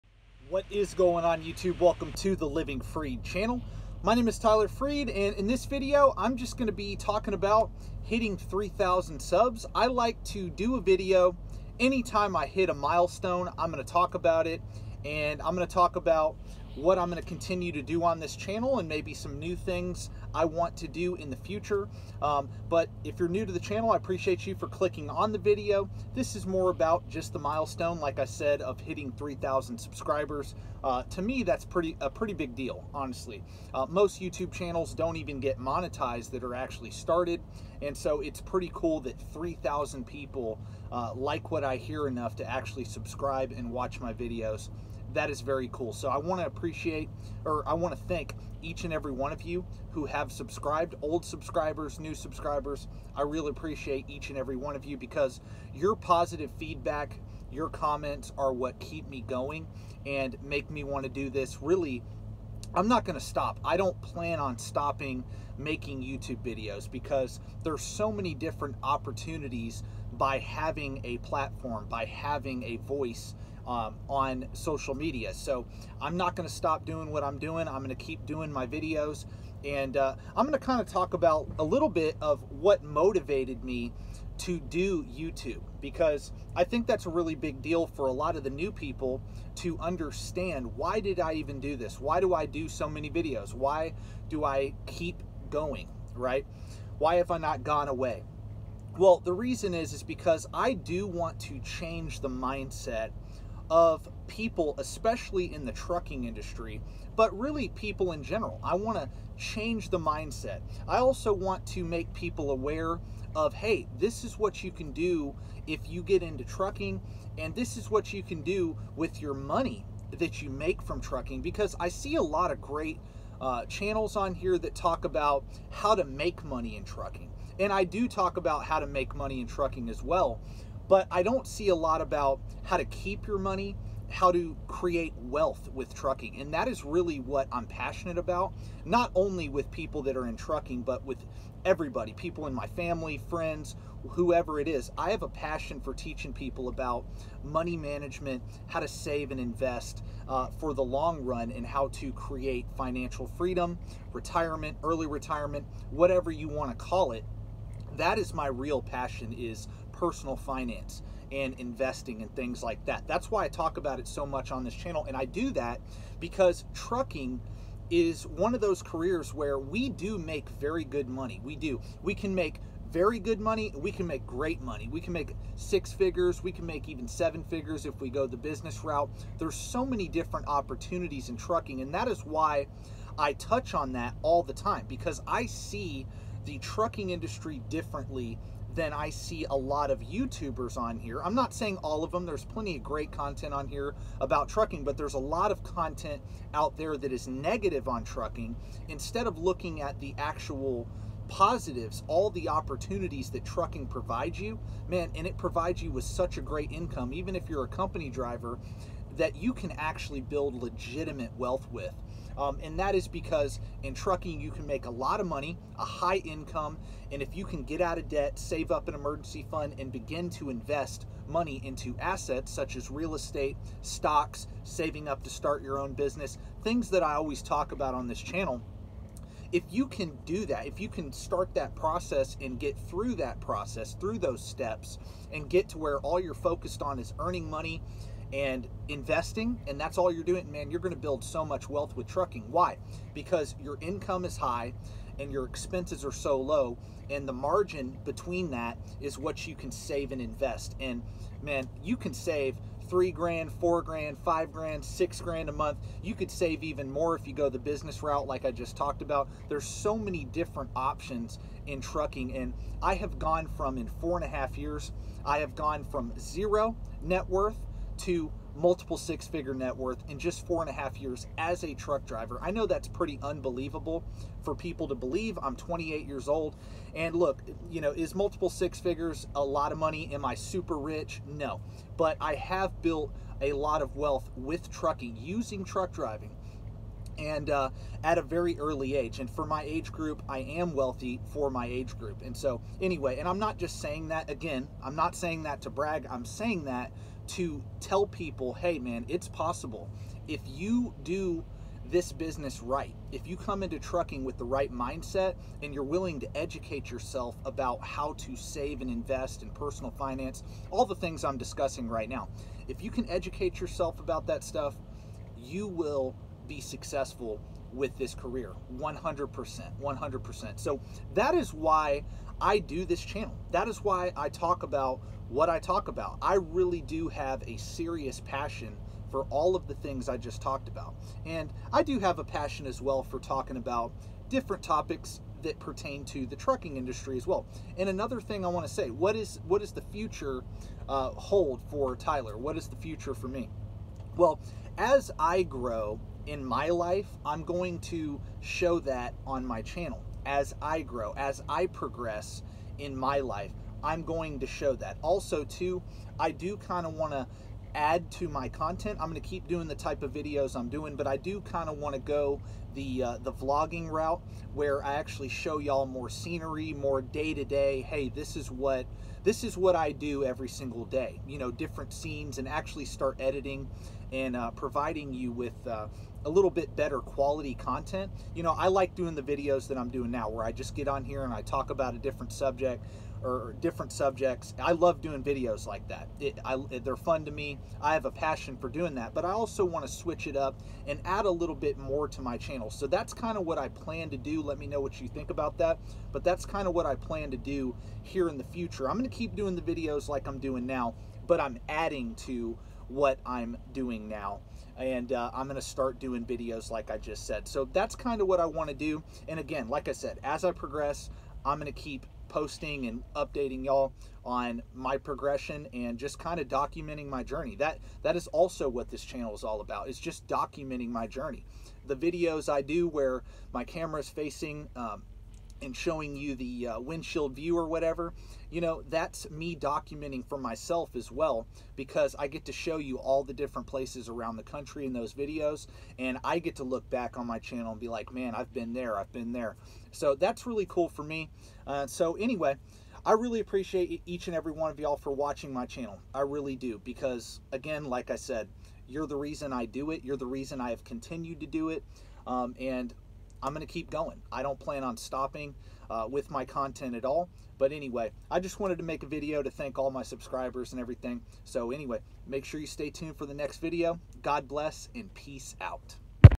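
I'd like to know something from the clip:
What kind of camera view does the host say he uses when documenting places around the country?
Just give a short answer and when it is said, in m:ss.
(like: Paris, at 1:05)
windshield view, at 7:06.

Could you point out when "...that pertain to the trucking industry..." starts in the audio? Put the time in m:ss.
5:35.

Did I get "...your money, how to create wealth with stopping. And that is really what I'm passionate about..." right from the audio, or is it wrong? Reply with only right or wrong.
wrong.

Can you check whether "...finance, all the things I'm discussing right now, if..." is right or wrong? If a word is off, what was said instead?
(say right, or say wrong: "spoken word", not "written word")
right.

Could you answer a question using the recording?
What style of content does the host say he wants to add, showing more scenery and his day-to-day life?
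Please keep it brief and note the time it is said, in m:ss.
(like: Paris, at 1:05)
vlogging, at 6:03.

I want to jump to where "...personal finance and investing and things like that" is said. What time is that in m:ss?
2:40.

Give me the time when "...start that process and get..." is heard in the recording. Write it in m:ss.
3:51.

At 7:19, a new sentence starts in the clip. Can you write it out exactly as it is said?
So that's really cool for me.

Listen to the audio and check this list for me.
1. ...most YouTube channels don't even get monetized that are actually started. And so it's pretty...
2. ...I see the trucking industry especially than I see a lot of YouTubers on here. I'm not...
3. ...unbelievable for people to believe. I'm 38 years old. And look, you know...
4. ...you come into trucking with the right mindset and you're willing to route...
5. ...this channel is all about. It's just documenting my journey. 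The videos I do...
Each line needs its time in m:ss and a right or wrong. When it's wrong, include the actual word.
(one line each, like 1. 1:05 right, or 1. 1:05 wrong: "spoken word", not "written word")
1. 0:33 right
2. 3:05 wrong: "differently", not "especially"
3. 4:33 wrong: "28", not "38"
4. 5:03 wrong: "educate", not "route"
5. 6:58 right.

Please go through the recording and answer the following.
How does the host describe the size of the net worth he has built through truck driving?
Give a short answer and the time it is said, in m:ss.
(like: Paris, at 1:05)
multiple six figure, at 4:28.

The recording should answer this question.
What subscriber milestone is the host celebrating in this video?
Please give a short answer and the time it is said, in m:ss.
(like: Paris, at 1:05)
3,000, at 0:08.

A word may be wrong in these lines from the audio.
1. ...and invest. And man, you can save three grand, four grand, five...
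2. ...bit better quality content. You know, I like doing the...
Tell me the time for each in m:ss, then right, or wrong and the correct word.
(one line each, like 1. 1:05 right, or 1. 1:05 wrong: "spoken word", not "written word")
1. 4:10 right
2. 6:16 right.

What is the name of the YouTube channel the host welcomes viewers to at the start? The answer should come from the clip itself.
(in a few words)
Living Freed.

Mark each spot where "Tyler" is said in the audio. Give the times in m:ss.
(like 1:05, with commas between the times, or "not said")
0:04, 5:41.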